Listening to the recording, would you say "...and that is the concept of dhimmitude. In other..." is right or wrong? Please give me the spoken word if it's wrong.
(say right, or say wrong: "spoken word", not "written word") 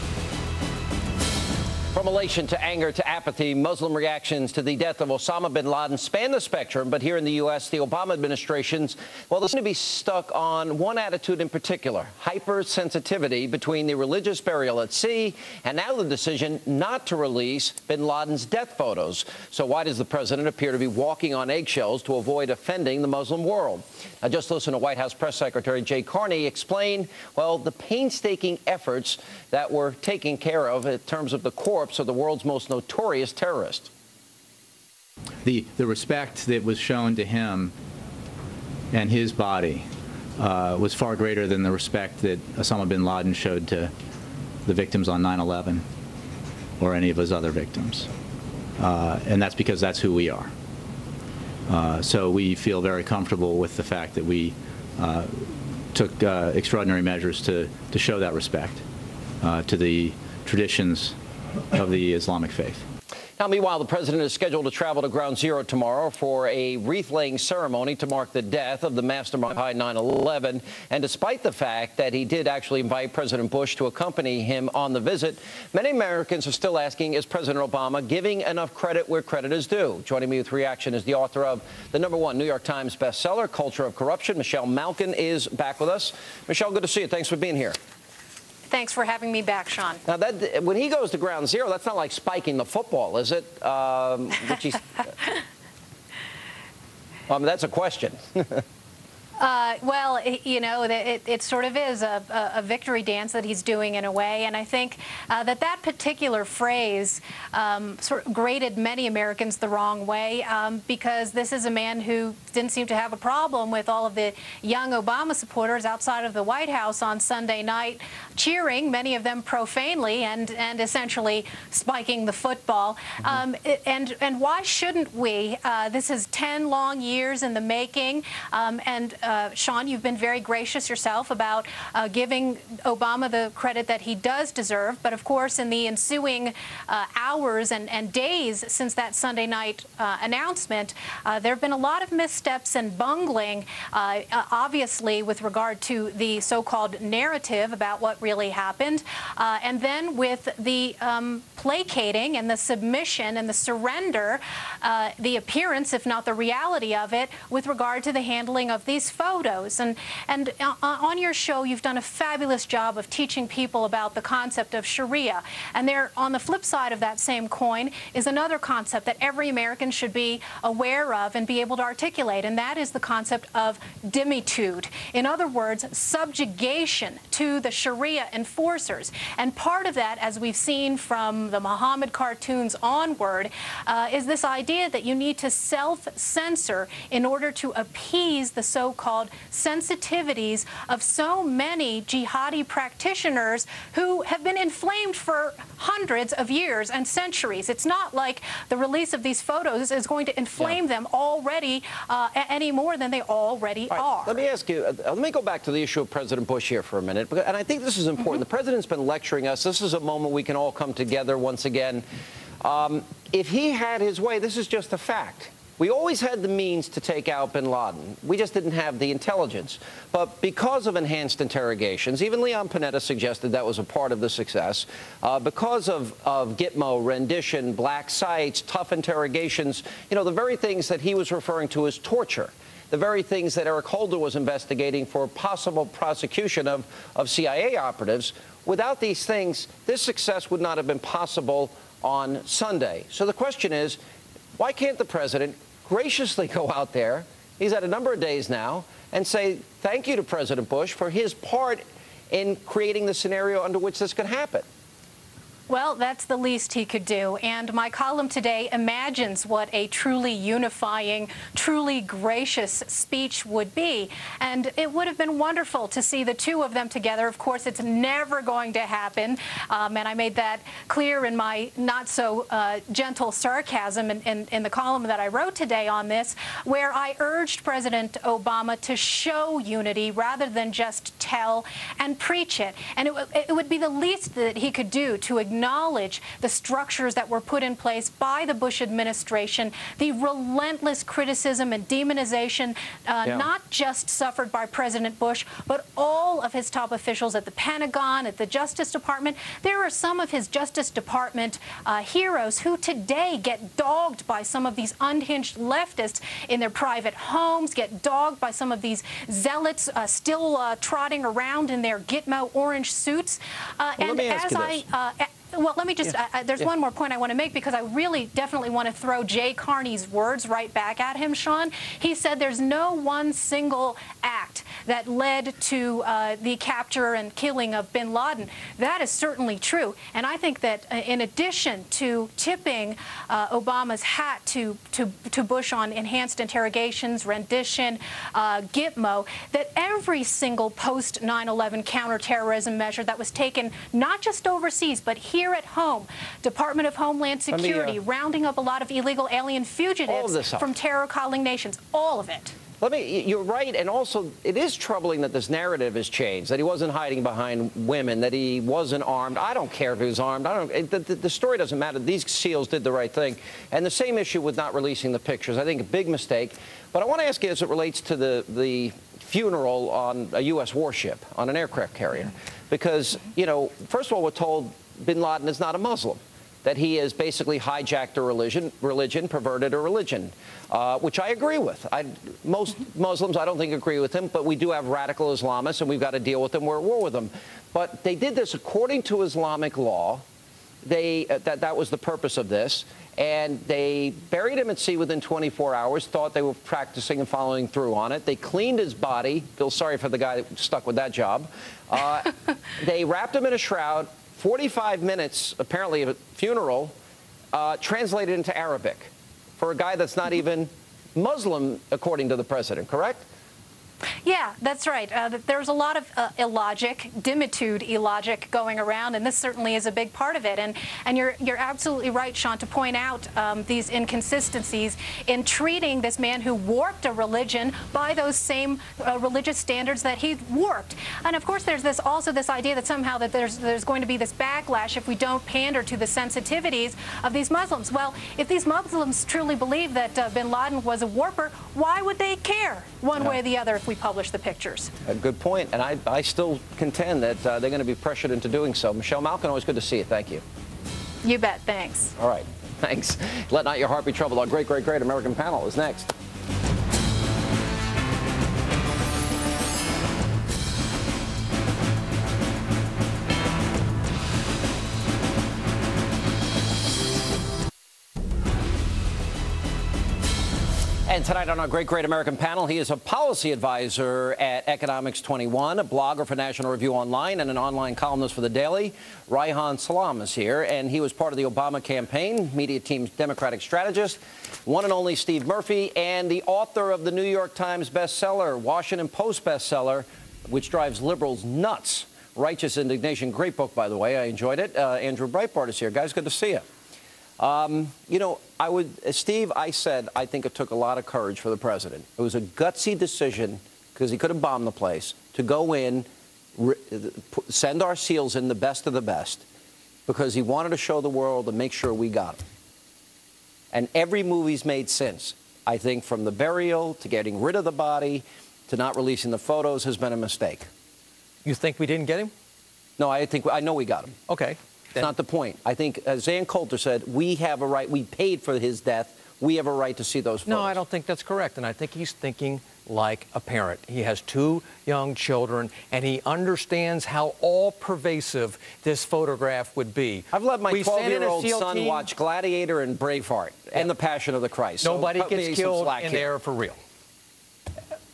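right.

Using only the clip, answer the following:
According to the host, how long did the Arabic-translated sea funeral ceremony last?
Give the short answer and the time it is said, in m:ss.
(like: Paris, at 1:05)
45 minutes, at 6:44.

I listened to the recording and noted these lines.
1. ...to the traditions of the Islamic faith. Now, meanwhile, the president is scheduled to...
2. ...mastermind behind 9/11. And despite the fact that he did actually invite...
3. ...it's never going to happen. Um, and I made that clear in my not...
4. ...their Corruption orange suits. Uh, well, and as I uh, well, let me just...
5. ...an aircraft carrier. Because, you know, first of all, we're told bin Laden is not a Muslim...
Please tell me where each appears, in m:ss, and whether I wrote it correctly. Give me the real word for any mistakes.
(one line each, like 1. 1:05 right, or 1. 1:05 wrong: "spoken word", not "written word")
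1. 0:59 right
2. 1:09 right
3. 4:27 right
4. 5:11 wrong: "Gitmo", not "Corruption"
5. 6:11 right.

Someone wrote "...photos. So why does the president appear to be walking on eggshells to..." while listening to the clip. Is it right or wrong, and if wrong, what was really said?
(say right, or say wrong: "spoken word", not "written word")
right.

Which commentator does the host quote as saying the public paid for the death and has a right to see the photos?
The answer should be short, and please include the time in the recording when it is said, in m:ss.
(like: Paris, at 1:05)
Ann Coulter, at 8:46.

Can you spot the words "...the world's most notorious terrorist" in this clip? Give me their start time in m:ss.
0:32.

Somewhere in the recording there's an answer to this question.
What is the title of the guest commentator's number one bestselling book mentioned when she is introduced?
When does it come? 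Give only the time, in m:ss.
1:23.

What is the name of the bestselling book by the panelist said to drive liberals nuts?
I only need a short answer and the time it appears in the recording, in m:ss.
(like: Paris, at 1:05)
Righteous Indignation, at 8:12.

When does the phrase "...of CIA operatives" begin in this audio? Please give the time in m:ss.
3:57.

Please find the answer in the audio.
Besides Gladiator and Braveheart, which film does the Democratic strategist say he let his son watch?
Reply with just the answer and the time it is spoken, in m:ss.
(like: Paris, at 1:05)
The Passion of the Christ, at 9:03.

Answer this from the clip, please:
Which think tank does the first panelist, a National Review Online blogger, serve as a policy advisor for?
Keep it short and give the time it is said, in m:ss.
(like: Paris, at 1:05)
Economics 21, at 7:54.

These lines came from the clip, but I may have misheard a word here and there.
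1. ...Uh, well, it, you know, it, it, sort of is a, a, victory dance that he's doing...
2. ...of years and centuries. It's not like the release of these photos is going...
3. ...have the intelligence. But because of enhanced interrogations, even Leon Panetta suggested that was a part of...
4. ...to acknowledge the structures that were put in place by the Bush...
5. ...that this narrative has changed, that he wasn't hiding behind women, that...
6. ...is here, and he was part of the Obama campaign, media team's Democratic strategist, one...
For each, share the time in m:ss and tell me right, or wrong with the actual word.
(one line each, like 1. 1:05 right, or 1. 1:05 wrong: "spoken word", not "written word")
1. 1:39 right
2. 3:16 right
3. 3:38 right
4. 4:45 right
5. 5:55 right
6. 8:00 right.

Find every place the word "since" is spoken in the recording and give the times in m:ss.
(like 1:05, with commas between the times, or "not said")
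2:18, 8:34.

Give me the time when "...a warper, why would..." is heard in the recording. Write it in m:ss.
7:21.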